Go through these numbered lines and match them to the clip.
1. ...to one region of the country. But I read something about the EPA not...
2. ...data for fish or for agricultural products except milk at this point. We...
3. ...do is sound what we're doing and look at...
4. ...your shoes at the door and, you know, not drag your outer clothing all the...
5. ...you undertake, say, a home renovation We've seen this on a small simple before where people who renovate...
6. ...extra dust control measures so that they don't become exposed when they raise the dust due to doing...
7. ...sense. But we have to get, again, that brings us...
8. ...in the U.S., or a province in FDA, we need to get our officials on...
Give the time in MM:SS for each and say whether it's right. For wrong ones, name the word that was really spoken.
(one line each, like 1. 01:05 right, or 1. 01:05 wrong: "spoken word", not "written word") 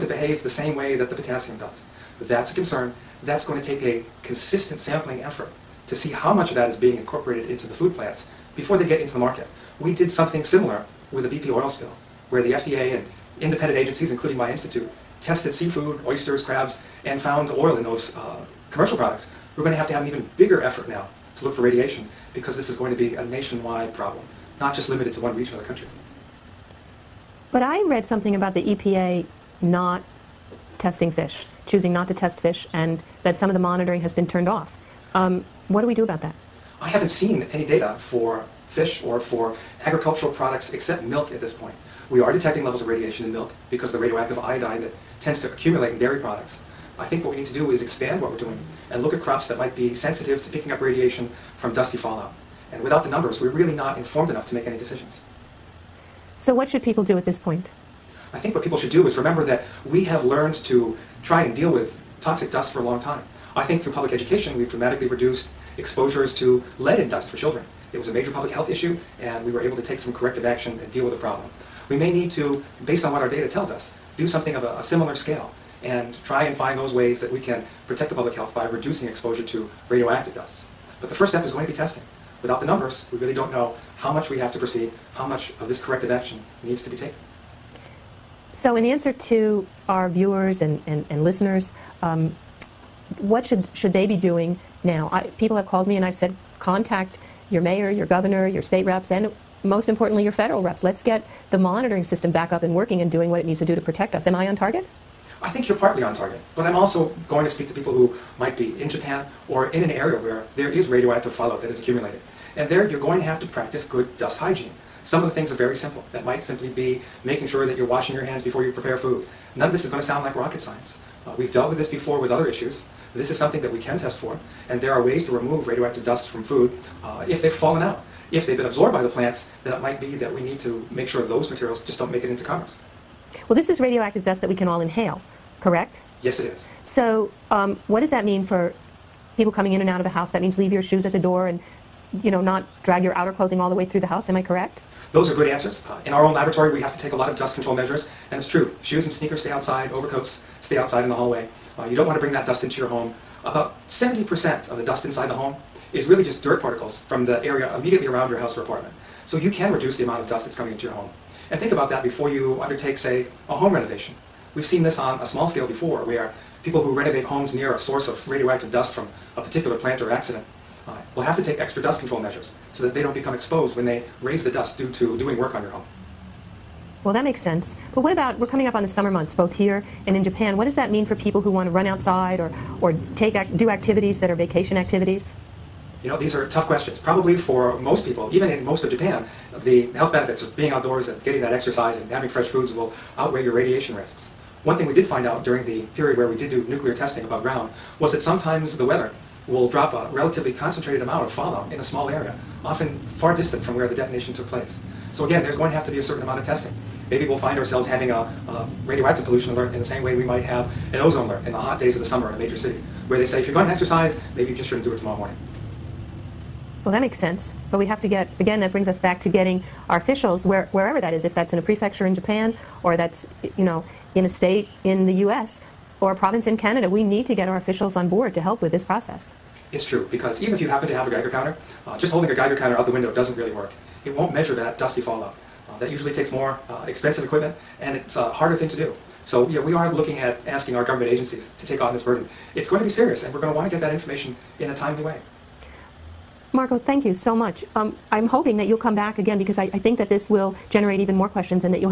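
1. 00:25 right
2. 00:37 right
3. 00:47 wrong: "expand", not "sound"
4. 02:20 right
5. 02:42 wrong: "scale", not "simple"
6. 02:51 right
7. 03:37 right
8. 03:44 wrong: "Canada", not "FDA".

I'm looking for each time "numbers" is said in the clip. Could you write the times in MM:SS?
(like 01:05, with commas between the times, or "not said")
00:53, 01:22.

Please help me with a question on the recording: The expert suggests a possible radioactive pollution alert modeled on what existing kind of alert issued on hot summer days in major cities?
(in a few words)
Ozone alert.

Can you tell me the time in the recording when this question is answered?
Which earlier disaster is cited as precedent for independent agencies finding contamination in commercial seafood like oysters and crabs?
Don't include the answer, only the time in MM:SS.
00:11.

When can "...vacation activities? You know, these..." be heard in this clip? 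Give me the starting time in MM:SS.
03:04.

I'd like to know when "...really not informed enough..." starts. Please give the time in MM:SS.
00:53.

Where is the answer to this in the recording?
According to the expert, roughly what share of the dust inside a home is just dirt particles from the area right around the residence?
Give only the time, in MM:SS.
02:33.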